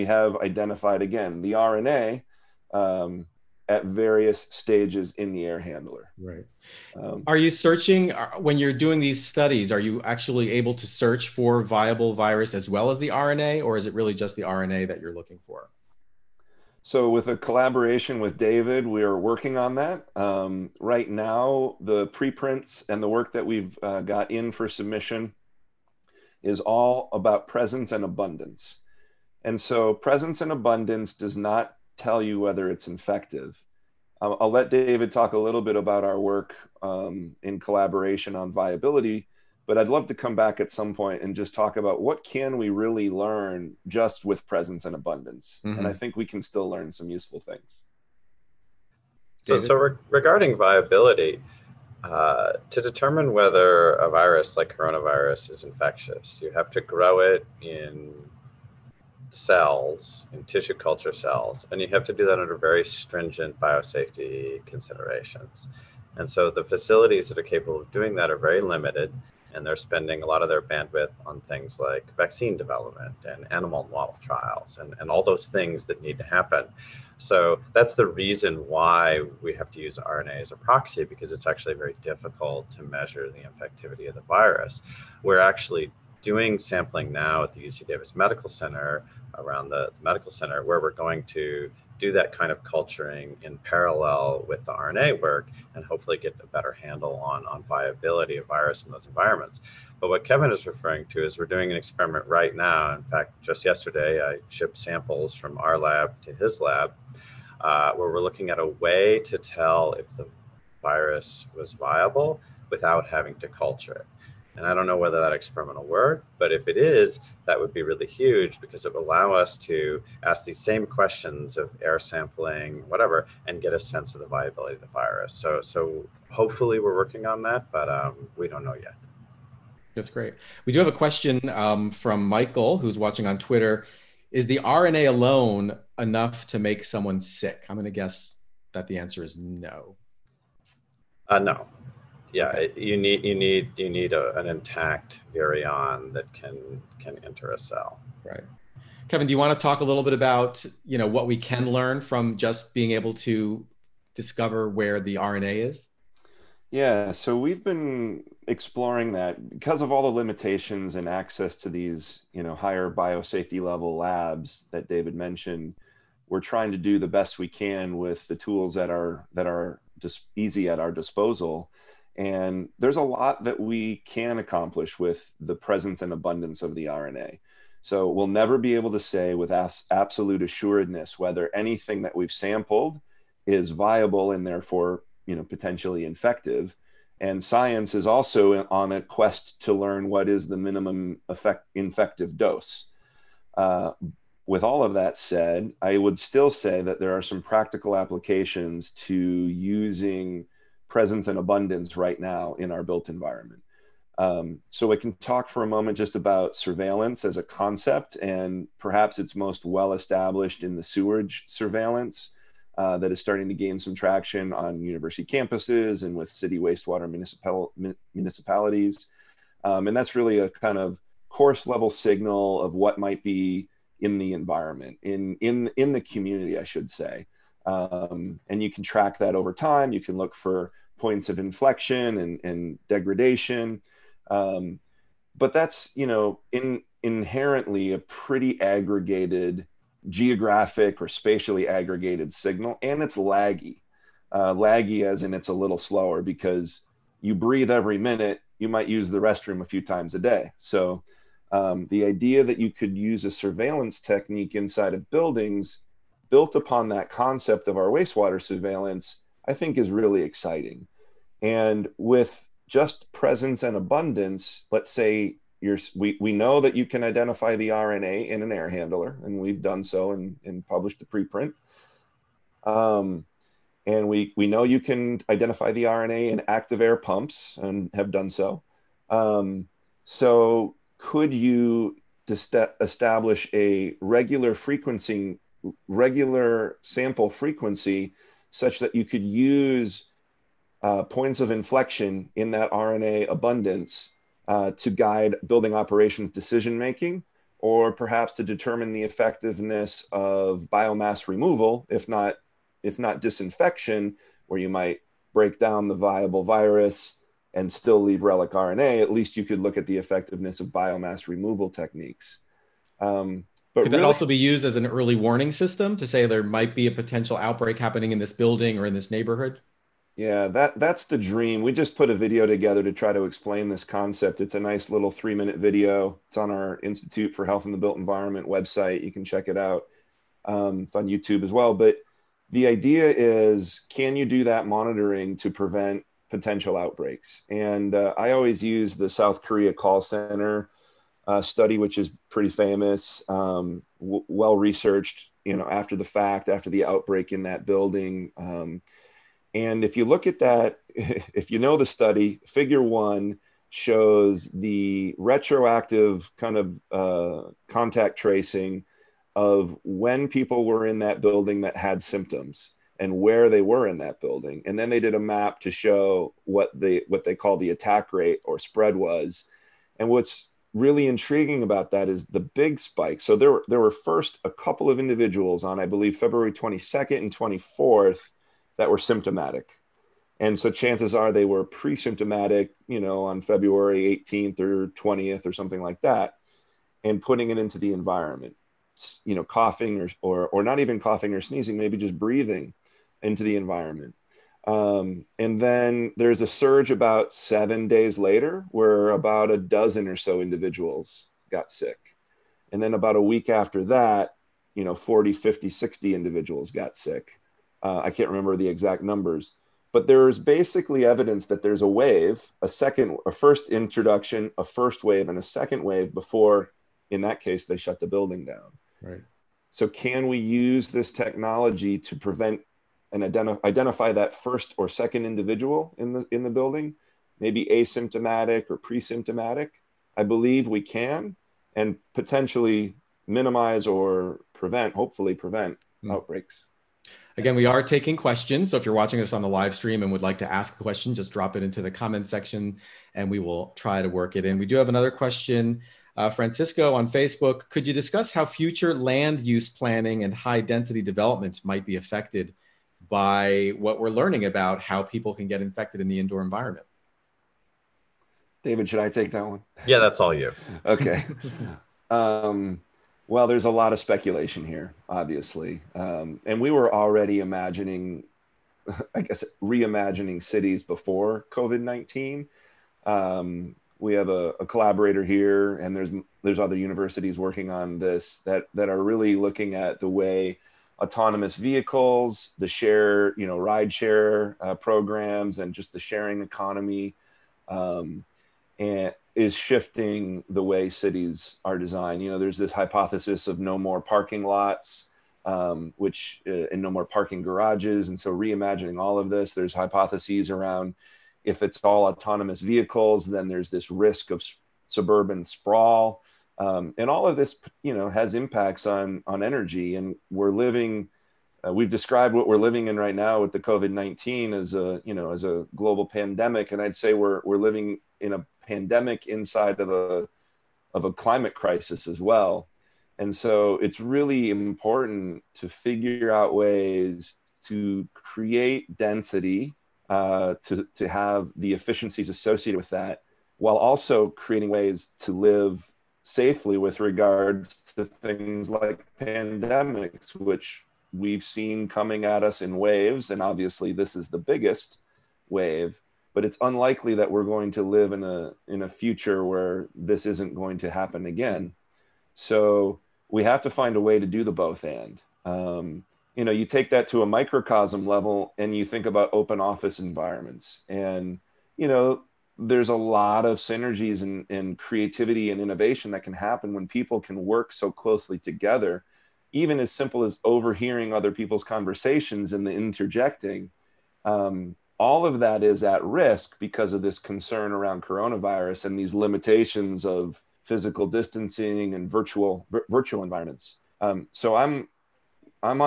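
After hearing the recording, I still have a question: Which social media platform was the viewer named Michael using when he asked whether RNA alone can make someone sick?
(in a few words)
Twitter.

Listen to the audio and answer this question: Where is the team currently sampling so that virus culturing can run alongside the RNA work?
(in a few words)
UC Davis Medical Center.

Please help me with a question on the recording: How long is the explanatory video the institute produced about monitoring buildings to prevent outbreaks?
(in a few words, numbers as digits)
3 minutes.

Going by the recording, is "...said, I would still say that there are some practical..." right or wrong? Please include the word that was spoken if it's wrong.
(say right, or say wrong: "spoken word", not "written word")
right.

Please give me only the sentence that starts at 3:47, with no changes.
Um, and you can track that over time.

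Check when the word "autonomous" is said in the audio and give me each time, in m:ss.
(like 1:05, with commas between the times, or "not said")
8:01, 8:22.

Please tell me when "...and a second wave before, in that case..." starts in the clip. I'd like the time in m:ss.
6:55.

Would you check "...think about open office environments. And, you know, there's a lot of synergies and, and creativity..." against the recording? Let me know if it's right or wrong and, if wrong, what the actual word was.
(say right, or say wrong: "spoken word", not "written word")
right.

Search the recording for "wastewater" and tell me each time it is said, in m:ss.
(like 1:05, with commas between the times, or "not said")
3:36, 4:17.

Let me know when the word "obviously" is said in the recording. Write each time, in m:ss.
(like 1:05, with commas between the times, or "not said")
7:45, 9:03.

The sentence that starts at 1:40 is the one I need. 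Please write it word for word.
But what Kevin is referring to is we're doing an experiment right now.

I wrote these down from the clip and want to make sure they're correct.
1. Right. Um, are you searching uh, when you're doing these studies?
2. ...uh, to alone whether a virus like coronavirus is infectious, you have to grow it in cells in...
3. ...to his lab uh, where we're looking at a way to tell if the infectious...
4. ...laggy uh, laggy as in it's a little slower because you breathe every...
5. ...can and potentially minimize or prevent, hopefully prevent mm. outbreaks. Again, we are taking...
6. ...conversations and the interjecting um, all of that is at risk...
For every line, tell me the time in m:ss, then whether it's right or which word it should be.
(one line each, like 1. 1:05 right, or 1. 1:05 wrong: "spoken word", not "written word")
1. 0:06 right
2. 0:52 wrong: "determine", not "alone"
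3. 1:46 wrong: "virus", not "infectious"
4. 4:03 right
5. 7:10 right
6. 9:31 right.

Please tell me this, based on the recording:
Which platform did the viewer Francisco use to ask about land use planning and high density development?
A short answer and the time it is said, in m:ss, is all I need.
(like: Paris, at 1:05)
Facebook, at 7:27.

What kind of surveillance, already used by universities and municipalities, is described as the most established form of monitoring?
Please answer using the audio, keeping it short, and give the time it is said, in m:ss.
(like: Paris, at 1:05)
Sewage surveillance, at 3:30.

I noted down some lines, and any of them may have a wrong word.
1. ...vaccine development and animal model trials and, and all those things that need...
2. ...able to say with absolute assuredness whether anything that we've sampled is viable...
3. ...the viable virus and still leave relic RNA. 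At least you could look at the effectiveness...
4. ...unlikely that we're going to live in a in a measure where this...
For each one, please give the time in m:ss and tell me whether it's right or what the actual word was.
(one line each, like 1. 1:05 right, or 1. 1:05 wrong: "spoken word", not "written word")
1. 1:12 right
2. 2:58 right
3. 5:05 right
4. 9:06 wrong: "future", not "measure".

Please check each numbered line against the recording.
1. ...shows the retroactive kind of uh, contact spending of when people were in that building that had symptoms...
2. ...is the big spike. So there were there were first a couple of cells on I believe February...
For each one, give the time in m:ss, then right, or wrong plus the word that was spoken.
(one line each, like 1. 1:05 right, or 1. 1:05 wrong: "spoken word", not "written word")
1. 5:53 wrong: "tracing", not "spending"
2. 6:12 wrong: "individuals", not "cells".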